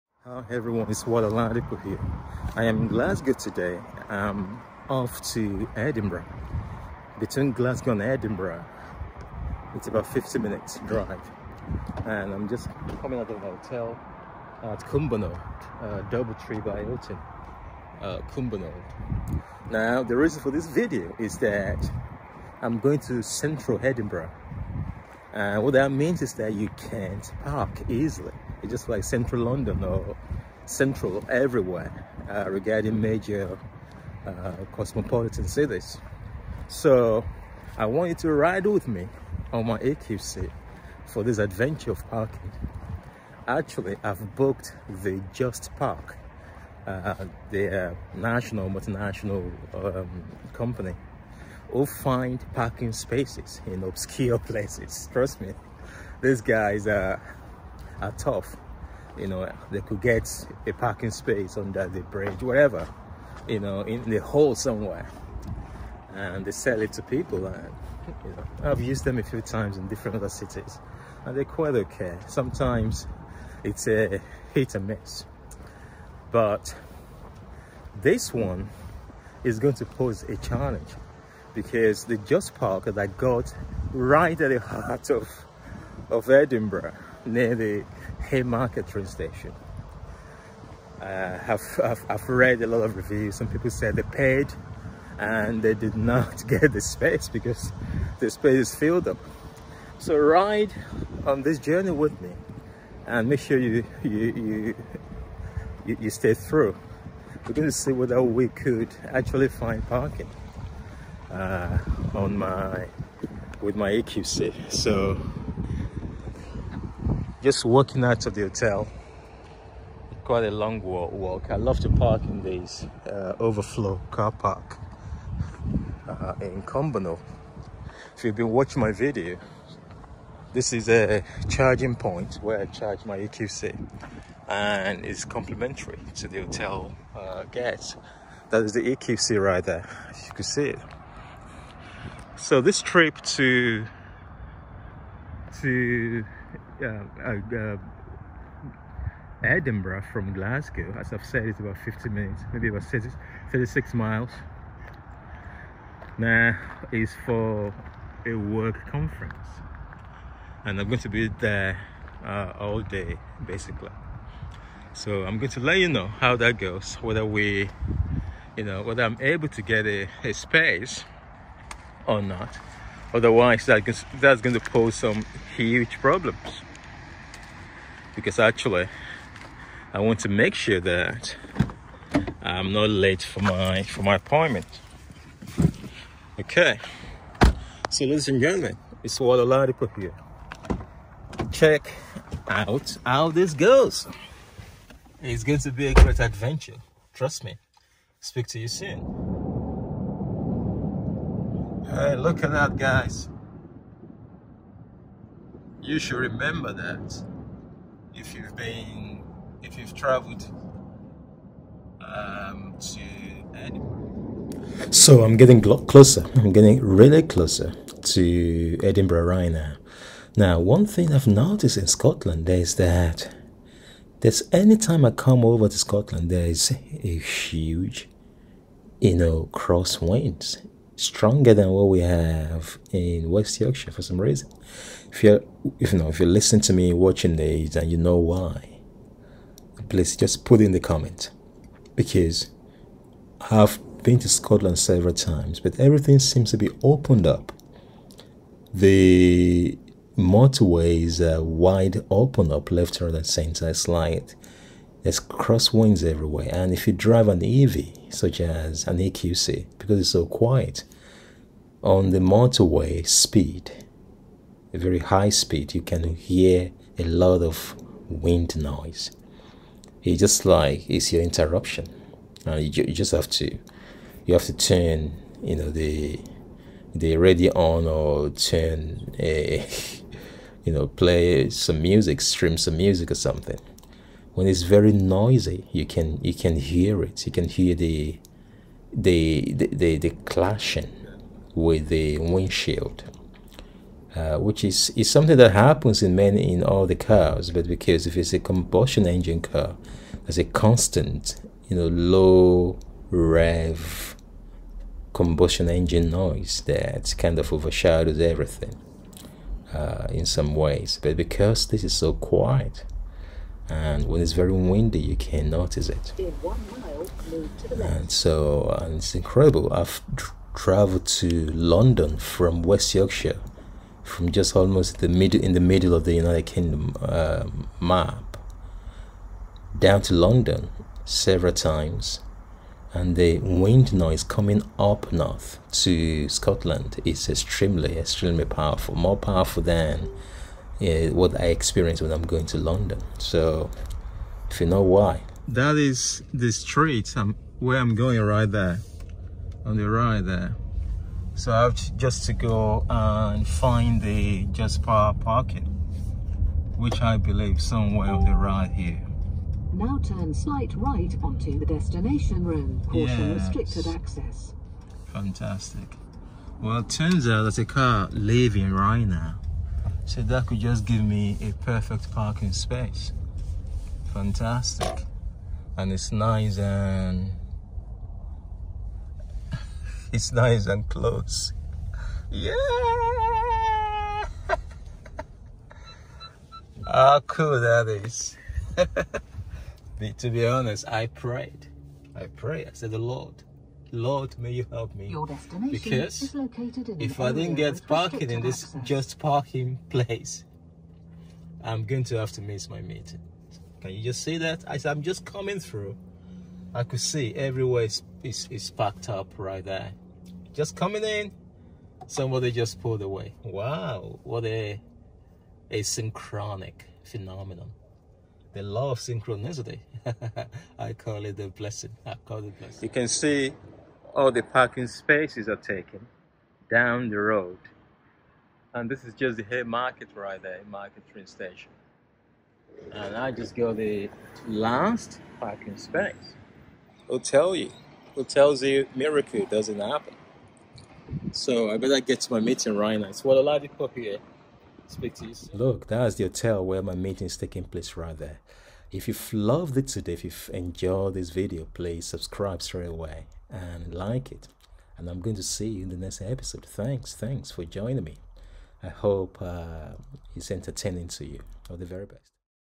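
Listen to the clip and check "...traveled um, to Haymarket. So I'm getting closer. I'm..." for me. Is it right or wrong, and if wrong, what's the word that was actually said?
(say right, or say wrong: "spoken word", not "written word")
wrong: "Edinburgh", not "Haymarket".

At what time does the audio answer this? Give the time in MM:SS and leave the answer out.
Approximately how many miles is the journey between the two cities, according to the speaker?
02:32.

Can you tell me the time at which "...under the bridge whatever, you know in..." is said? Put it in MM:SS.
01:01.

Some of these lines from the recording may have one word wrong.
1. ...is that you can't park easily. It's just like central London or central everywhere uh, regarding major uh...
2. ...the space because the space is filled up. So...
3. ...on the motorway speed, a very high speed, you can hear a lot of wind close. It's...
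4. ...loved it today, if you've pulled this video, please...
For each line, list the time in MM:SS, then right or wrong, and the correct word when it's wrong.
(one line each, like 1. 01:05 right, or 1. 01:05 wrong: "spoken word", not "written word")
1. 00:26 right
2. 01:36 right
3. 04:21 wrong: "noise", not "close"
4. 07:29 wrong: "enjoyed", not "pulled".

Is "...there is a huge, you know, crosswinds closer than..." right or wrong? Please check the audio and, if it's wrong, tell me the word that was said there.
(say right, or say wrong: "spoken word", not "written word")
wrong: "stronger", not "closer".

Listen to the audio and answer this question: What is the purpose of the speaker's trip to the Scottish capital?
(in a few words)
Work conference.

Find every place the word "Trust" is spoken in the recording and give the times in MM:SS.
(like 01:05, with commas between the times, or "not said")
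00:55, 03:17.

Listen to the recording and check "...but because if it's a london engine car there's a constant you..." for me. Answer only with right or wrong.
wrong.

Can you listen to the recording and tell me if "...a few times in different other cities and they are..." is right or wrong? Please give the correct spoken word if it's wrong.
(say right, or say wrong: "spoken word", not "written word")
right.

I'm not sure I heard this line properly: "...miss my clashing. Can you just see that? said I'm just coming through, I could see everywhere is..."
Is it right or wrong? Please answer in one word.
wrong.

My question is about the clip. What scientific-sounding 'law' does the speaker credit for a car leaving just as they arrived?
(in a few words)
Law of synchronicity.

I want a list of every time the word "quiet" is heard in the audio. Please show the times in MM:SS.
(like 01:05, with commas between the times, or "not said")
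04:20, 05:12.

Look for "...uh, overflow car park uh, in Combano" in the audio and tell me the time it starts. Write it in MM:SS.
02:03.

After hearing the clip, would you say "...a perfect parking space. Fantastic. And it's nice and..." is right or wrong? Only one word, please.
right.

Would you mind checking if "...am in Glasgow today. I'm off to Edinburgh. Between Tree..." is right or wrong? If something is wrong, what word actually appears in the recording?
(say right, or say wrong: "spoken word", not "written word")
wrong: "Glasgow", not "Tree".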